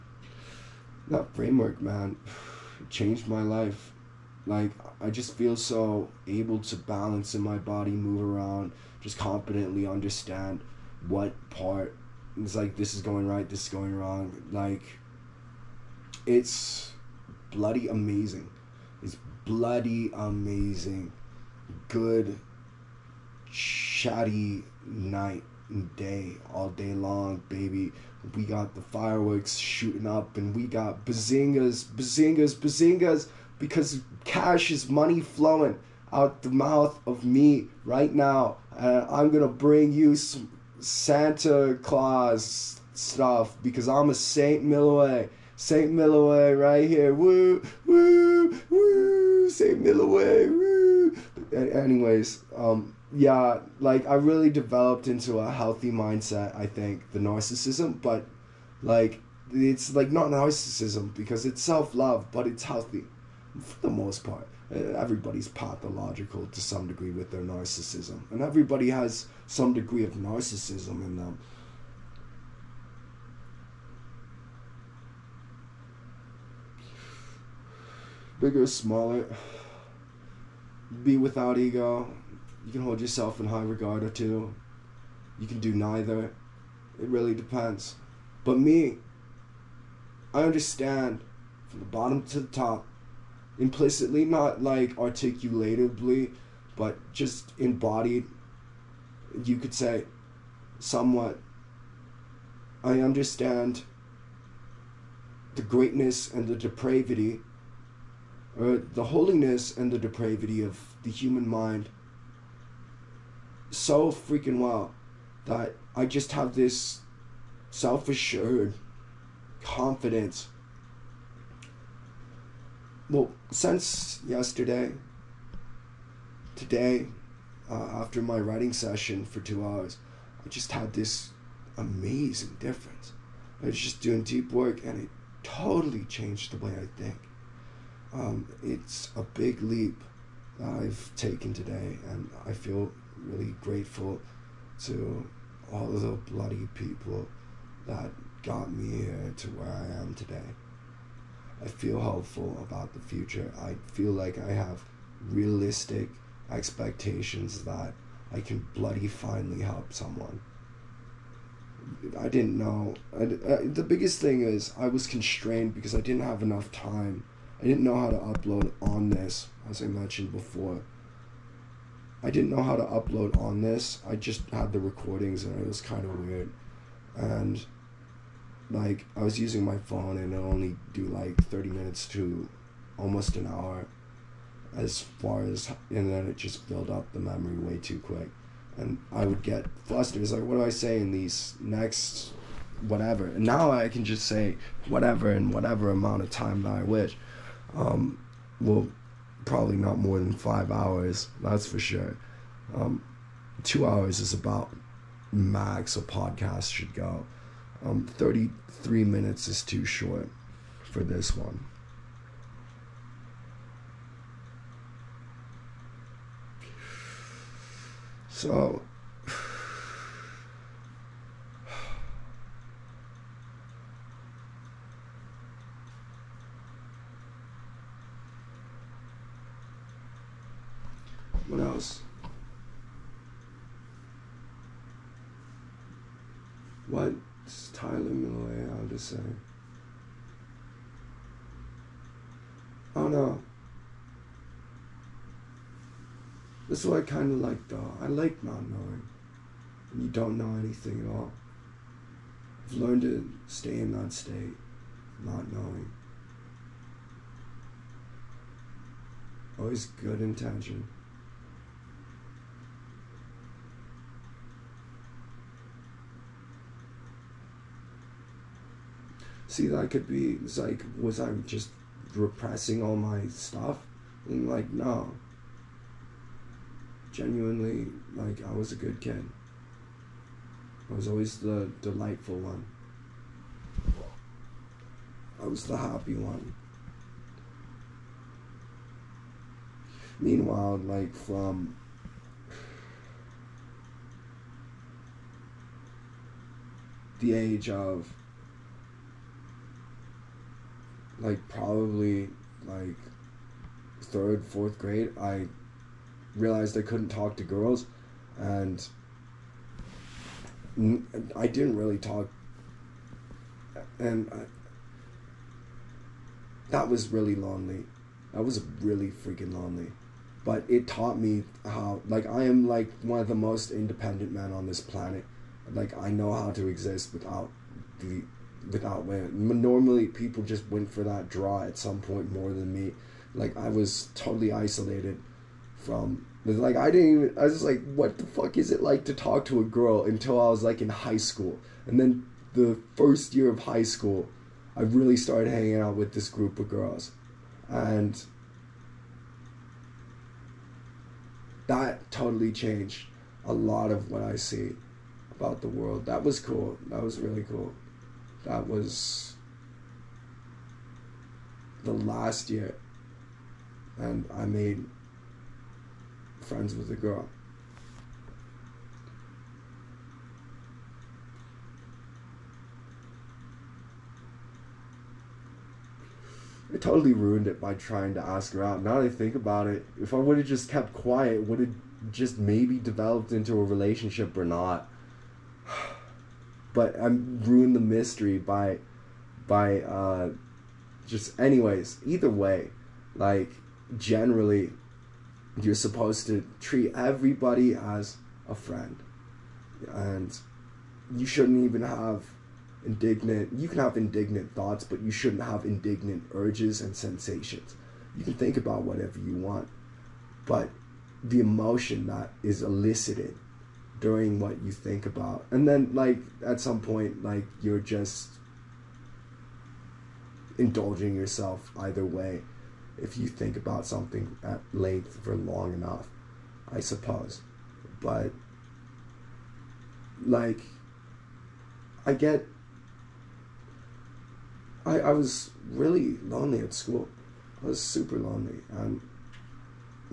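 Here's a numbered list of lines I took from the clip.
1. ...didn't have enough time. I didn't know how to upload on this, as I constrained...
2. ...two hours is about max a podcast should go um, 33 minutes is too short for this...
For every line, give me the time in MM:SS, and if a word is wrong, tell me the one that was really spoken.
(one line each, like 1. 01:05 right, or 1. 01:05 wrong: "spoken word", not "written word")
1. 02:46 wrong: "mentioned", not "constrained"
2. 03:23 right.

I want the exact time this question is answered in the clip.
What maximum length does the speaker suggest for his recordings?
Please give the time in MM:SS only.
03:19.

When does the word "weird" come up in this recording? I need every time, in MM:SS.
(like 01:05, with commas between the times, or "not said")
02:56.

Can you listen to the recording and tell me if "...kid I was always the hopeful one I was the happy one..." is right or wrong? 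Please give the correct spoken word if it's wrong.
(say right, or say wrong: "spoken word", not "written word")
wrong: "delightful", not "hopeful".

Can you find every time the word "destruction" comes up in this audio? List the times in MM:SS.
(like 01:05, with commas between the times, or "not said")
not said.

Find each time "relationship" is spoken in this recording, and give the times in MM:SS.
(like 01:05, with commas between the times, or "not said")
06:23.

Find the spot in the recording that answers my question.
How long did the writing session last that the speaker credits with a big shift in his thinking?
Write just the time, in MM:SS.
02:08.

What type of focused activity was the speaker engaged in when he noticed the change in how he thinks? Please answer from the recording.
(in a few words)
deep work.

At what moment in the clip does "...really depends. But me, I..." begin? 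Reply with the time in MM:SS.
01:27.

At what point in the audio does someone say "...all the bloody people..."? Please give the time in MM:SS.
02:25.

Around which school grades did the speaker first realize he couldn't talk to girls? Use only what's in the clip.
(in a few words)
third, fourth grade.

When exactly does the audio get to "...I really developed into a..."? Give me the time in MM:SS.
00:54.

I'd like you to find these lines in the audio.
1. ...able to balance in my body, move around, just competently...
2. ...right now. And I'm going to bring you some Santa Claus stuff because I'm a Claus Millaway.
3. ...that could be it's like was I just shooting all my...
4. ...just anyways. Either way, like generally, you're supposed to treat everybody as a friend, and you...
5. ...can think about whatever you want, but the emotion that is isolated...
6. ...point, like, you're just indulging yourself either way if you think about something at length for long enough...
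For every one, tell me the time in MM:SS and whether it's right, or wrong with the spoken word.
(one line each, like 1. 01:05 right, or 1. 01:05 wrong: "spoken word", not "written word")
1. 00:06 right
2. 00:37 wrong: "Saint", not "Claus"
3. 04:29 wrong: "repressing", not "shooting"
4. 06:31 right
5. 06:48 wrong: "elicited", not "isolated"
6. 06:56 right.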